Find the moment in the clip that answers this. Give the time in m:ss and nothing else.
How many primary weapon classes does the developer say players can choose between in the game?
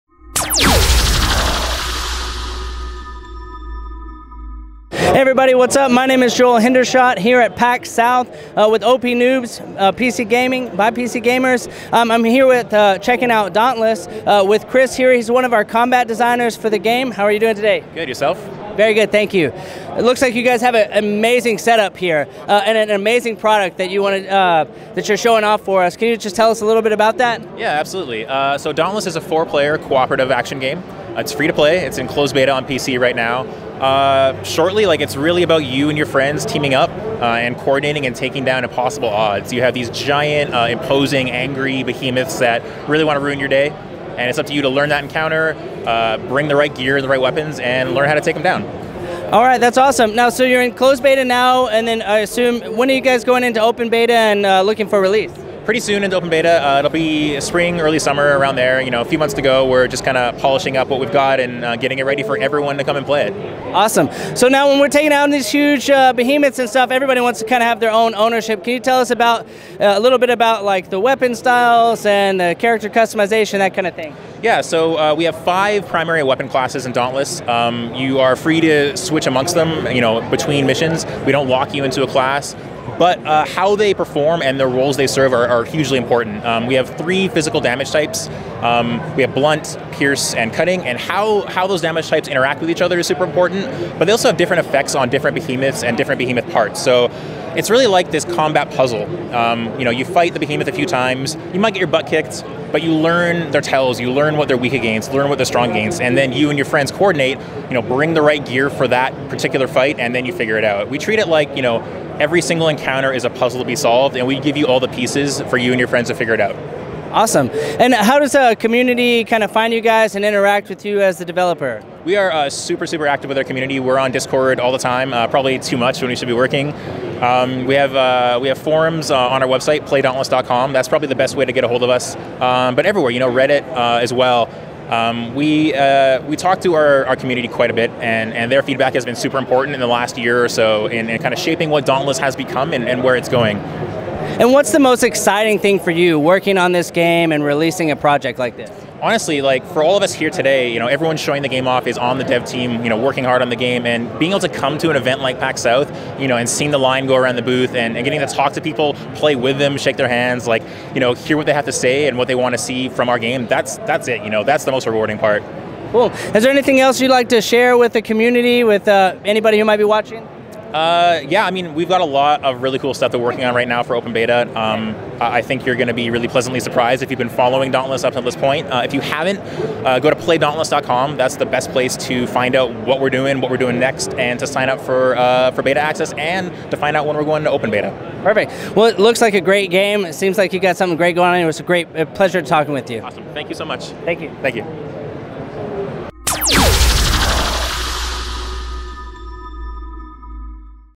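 1:15.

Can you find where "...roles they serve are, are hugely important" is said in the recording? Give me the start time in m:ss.
1:24.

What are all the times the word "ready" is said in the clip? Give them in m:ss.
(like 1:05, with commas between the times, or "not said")
1:02.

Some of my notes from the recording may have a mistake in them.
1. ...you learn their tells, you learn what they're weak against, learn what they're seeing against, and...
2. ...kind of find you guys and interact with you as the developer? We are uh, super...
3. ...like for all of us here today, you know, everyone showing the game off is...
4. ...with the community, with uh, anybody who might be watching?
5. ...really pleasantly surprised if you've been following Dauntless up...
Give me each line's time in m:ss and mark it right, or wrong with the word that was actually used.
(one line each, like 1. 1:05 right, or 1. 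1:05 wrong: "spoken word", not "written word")
1. 1:42 wrong: "strong", not "seeing"
2. 1:59 right
3. 2:29 right
4. 2:47 right
5. 2:56 right.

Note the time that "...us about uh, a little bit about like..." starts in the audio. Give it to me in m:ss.
1:08.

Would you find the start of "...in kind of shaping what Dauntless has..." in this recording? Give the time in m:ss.
2:21.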